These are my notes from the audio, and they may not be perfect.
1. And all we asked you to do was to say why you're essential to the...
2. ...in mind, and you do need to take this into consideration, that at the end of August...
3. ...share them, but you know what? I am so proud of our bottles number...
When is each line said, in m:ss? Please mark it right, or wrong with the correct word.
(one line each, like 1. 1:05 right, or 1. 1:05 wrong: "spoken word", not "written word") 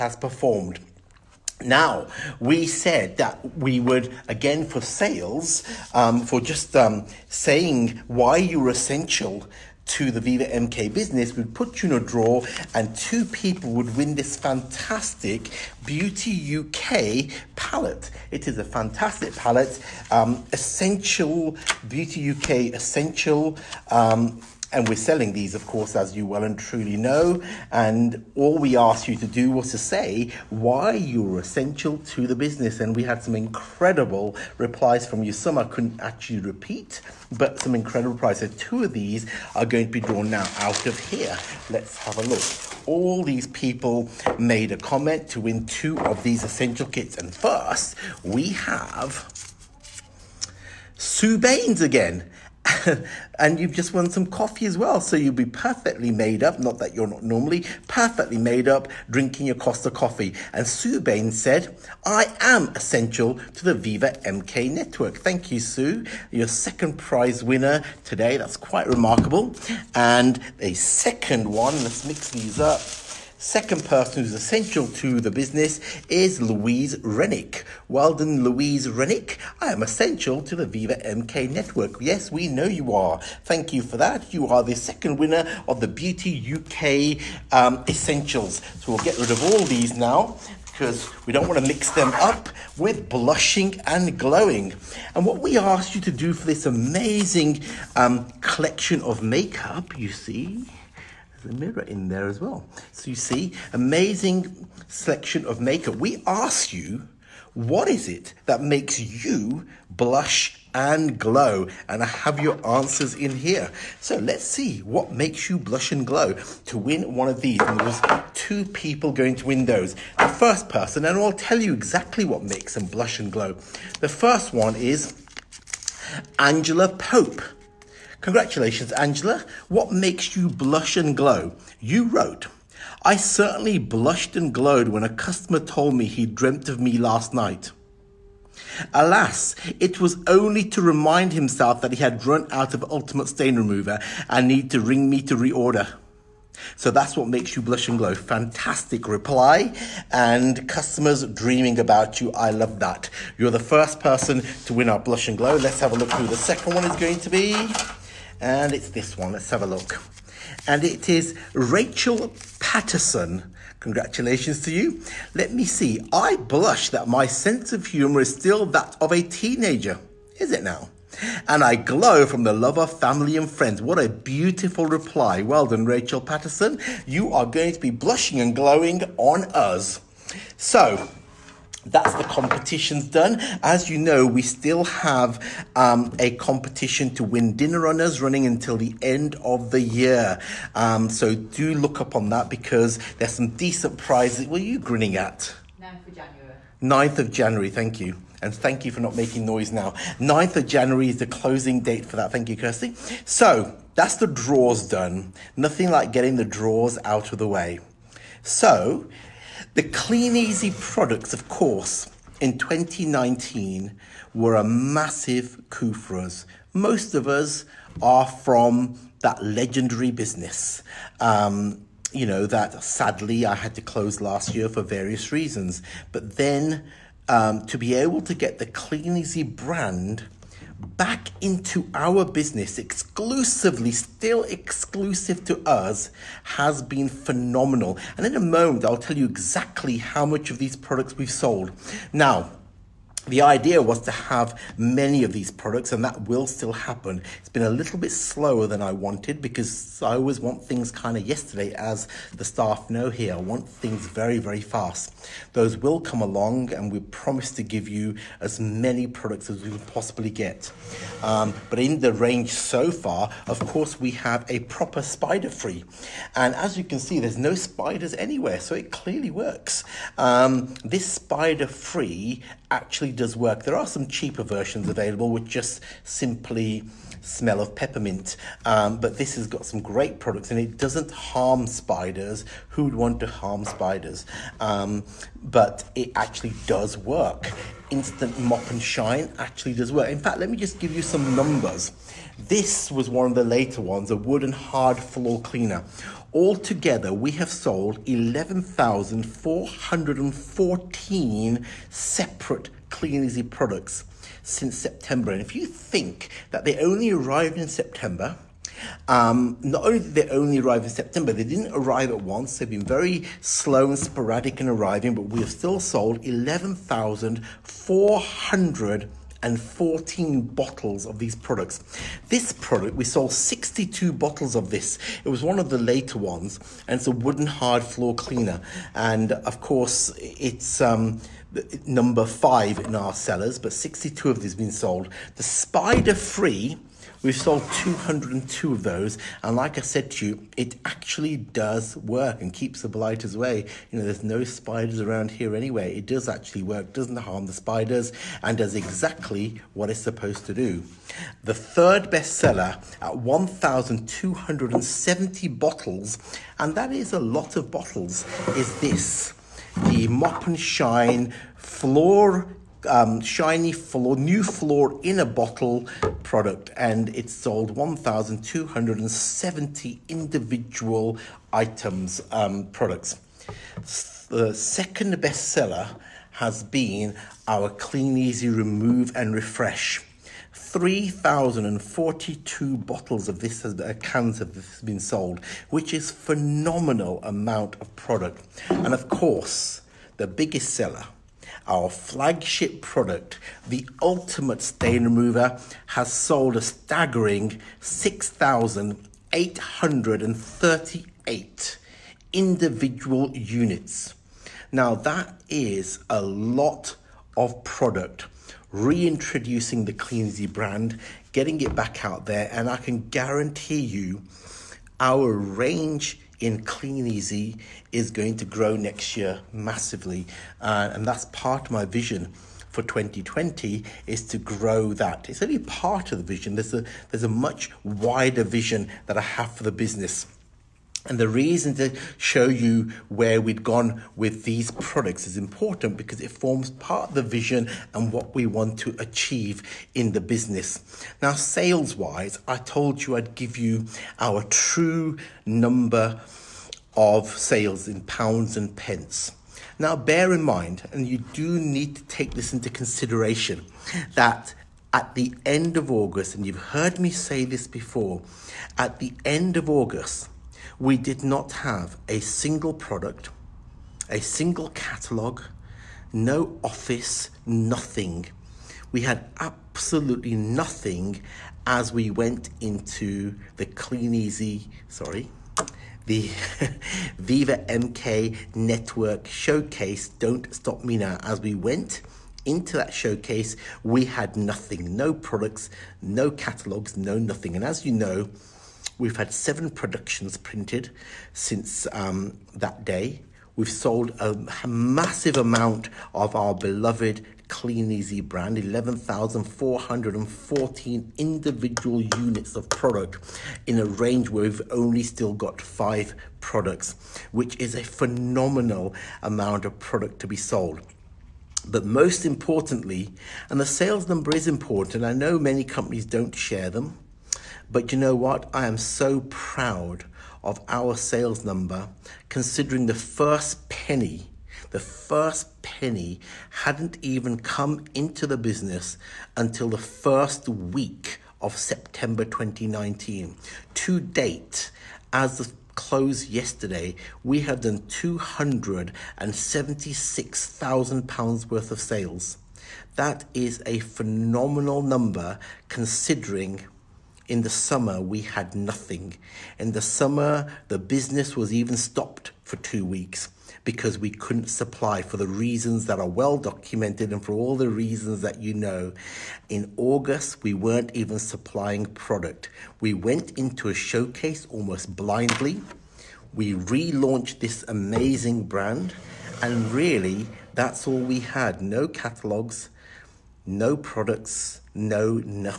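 1. 0:27 right
2. 7:30 right
3. 8:36 wrong: "sales", not "bottles".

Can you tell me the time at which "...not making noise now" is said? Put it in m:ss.
3:19.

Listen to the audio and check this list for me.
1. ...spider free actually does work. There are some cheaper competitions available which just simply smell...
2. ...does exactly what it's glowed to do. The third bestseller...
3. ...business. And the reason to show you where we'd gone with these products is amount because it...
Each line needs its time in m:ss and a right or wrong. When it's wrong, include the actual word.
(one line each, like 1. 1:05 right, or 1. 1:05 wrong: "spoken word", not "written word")
1. 4:31 wrong: "versions", not "competitions"
2. 5:48 wrong: "supposed", not "glowed"
3. 7:09 wrong: "important", not "amount".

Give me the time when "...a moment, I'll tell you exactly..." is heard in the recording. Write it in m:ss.
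3:58.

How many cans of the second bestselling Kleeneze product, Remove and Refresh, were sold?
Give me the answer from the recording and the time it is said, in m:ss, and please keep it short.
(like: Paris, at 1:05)
3,042, at 6:20.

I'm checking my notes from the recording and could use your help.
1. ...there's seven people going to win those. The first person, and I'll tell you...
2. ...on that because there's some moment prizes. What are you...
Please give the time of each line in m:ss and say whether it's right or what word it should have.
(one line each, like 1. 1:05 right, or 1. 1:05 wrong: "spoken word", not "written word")
1. 1:57 wrong: "two", not "seven"
2. 3:12 wrong: "decent", not "moment".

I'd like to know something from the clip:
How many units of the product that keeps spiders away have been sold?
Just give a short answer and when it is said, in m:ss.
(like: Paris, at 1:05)
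202, at 5:37.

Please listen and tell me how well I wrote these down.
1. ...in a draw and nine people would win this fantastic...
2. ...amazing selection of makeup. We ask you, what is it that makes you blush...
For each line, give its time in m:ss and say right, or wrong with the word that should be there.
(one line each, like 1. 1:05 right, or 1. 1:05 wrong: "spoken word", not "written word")
1. 0:11 wrong: "two", not "nine"
2. 1:43 right.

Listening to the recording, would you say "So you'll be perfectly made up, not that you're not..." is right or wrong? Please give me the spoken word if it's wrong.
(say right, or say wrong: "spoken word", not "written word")
right.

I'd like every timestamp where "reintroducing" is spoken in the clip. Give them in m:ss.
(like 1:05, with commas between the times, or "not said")
6:48.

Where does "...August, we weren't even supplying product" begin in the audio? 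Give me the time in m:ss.
9:19.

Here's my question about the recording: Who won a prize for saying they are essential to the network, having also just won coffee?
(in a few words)
Sue Baines.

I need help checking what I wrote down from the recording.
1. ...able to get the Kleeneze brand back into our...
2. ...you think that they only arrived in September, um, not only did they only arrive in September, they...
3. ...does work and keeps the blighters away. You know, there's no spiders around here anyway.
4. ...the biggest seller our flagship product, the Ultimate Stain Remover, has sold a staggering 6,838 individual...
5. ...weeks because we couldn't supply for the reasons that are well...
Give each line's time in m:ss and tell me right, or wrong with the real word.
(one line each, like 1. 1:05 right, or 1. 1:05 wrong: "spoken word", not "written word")
1. 3:47 right
2. 5:05 right
3. 5:41 right
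4. 6:30 right
5. 9:12 right.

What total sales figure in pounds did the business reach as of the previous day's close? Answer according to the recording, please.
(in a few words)
£276,000.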